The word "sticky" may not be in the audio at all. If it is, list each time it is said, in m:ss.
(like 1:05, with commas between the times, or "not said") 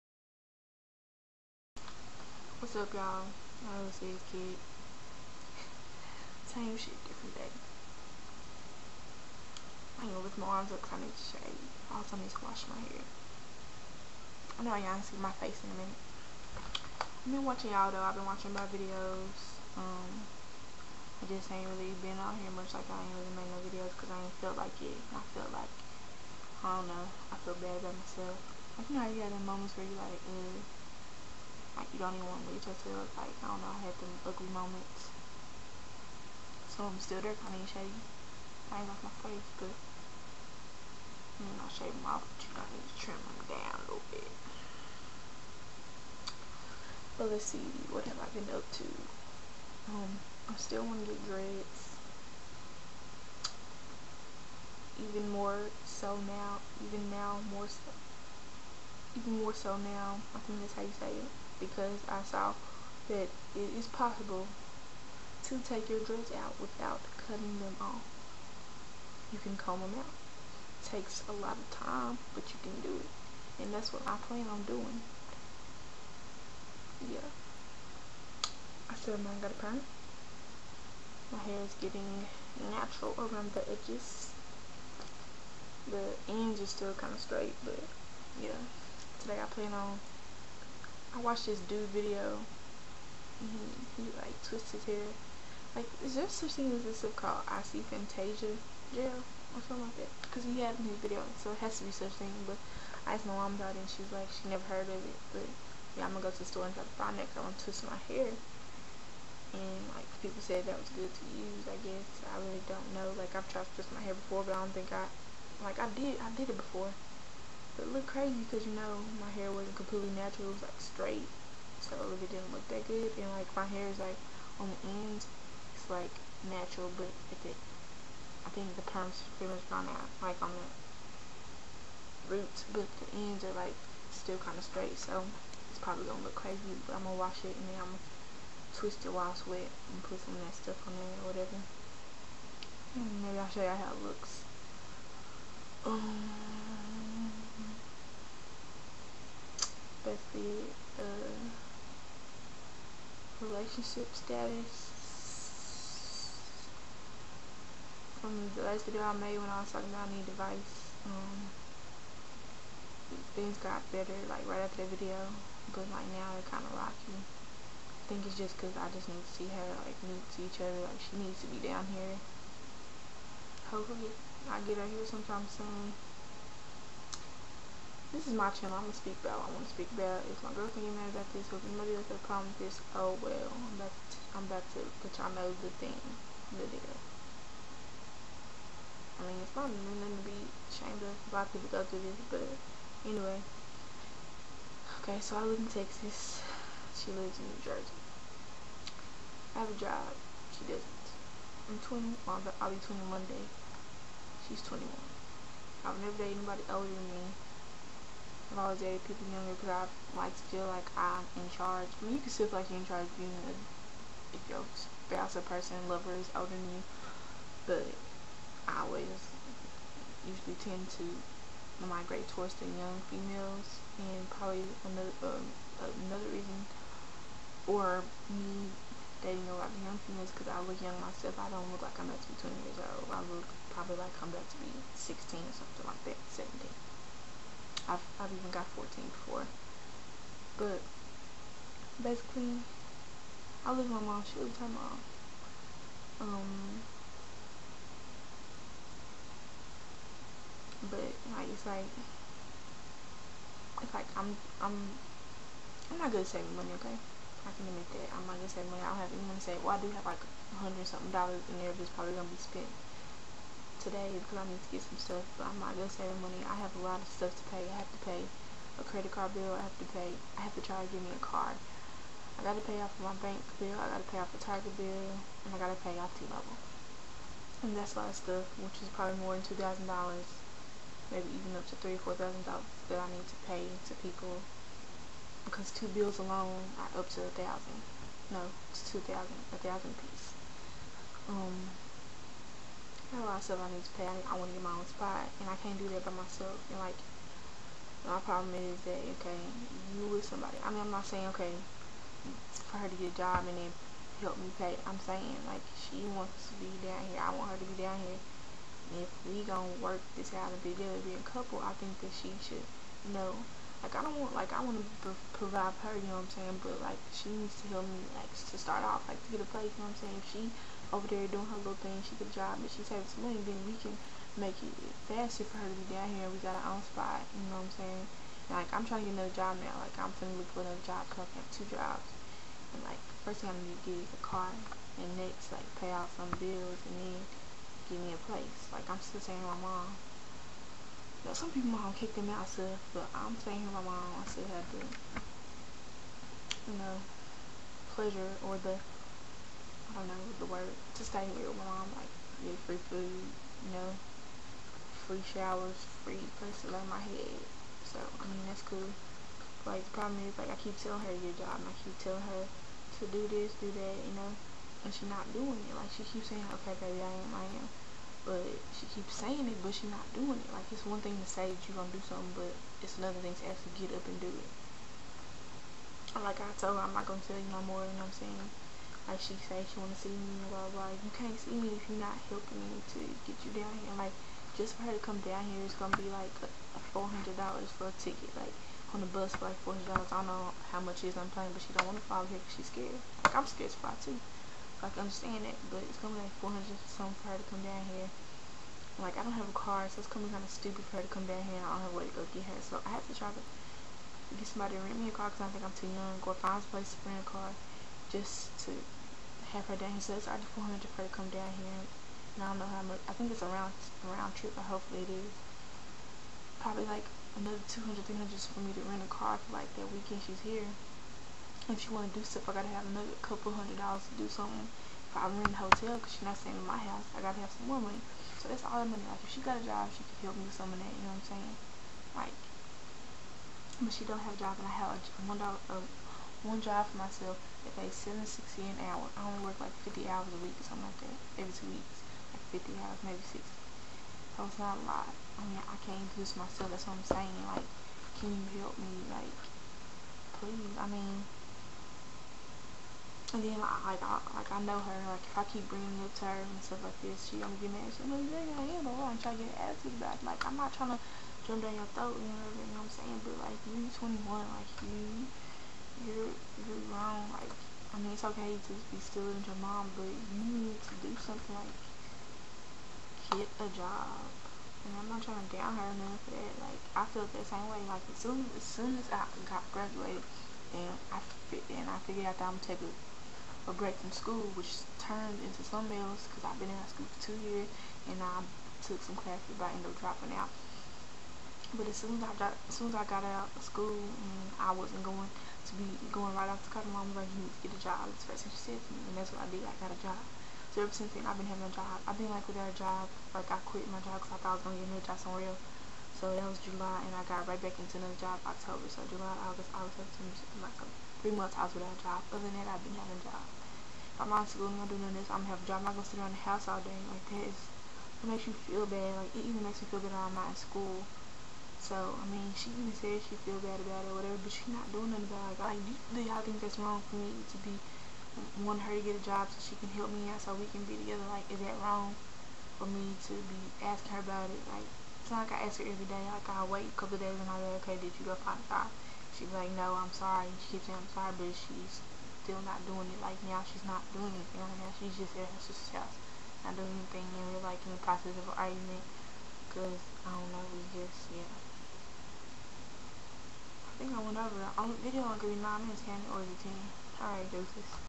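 not said.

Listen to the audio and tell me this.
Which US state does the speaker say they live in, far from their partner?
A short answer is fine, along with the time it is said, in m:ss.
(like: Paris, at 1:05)
Texas, at 3:15.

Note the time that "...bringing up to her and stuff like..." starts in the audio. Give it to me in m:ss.
7:35.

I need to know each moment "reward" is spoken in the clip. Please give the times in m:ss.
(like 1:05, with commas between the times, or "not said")
not said.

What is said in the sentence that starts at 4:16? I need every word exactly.
Okay, I can admit that I'm not good at saving money.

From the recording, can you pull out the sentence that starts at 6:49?
here, so I just 400 for her to come down here.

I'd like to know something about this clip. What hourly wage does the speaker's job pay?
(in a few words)
$7.60.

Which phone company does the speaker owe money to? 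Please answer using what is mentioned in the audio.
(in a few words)
T-Mobile.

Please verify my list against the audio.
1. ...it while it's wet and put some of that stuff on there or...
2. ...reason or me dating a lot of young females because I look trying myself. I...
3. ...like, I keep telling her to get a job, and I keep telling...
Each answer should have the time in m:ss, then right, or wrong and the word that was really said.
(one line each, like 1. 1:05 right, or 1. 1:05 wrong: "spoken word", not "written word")
1. 2:19 right
2. 3:46 wrong: "young", not "trying"
3. 6:00 right.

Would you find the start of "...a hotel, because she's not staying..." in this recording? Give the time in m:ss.
7:05.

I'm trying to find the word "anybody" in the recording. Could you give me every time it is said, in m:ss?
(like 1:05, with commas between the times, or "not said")
3:01, 3:26.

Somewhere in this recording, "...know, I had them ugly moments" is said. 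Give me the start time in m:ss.
0:33.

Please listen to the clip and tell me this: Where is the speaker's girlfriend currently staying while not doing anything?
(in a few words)
Her sister's house.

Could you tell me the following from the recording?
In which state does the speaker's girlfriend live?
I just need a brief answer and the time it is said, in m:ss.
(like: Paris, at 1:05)
New Jersey, at 3:17.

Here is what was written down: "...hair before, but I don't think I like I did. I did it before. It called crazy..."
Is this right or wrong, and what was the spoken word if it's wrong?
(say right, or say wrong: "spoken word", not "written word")
wrong: "looked", not "called".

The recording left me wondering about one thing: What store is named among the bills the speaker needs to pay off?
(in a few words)
Target.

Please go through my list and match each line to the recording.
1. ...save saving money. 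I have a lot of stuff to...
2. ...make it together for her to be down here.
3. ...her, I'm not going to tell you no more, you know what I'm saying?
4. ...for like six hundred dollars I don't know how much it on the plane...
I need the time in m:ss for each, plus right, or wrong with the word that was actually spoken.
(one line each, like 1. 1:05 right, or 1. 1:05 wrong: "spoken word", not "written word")
1. 4:25 right
2. 5:24 wrong: "faster", not "together"
3. 6:16 right
4. 6:29 wrong: "four", not "six".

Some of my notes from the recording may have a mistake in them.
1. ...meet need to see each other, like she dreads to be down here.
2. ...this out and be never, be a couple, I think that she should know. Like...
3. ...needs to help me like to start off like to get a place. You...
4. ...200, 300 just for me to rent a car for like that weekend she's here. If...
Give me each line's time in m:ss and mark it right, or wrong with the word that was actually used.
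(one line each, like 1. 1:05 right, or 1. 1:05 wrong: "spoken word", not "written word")
1. 2:50 wrong: "needs", not "dreads"
2. 5:10 wrong: "together", not "never"
3. 5:17 right
4. 6:57 right.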